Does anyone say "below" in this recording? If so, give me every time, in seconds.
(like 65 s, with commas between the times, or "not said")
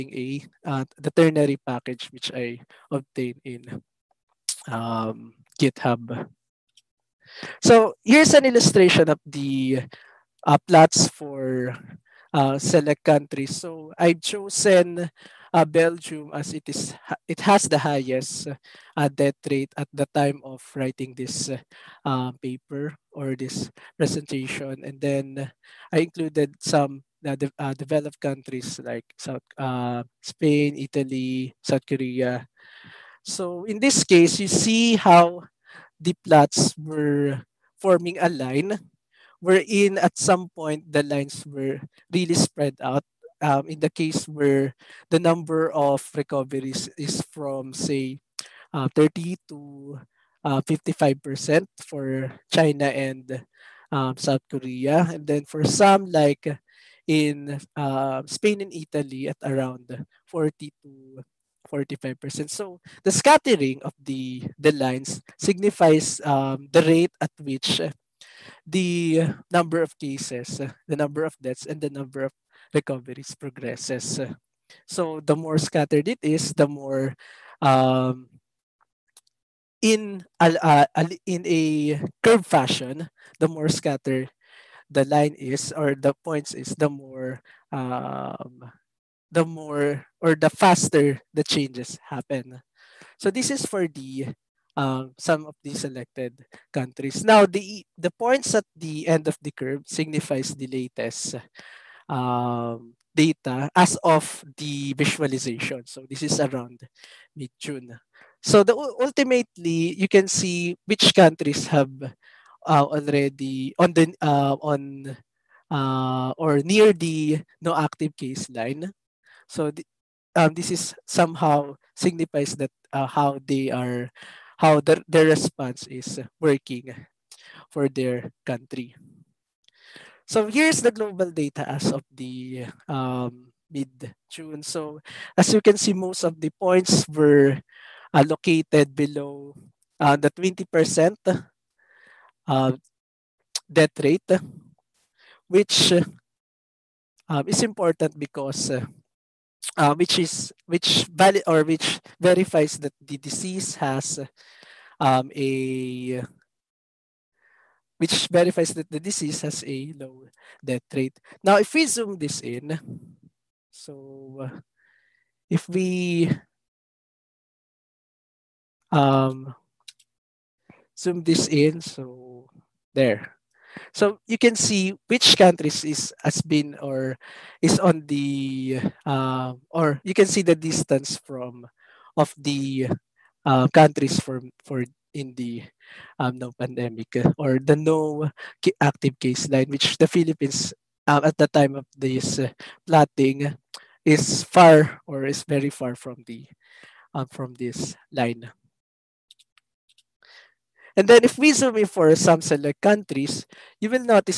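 138 s.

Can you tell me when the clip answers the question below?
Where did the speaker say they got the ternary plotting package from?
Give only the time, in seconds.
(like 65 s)
5 s.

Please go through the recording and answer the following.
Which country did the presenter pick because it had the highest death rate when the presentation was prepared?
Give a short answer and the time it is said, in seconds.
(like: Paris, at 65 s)
Belgium, at 15 s.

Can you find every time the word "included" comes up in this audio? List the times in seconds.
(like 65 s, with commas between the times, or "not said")
26 s.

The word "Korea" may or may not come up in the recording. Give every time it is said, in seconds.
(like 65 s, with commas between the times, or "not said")
31 s, 54 s.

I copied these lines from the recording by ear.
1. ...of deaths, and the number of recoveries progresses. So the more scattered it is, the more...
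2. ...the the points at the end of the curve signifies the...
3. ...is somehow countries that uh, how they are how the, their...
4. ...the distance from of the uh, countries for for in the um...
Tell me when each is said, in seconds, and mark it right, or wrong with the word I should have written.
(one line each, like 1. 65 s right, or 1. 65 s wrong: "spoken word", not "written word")
1. 71 s right
2. 97 s right
3. 120 s wrong: "signifies", not "countries"
4. 180 s right.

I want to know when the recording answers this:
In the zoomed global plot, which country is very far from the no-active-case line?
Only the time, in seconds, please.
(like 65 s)
190 s.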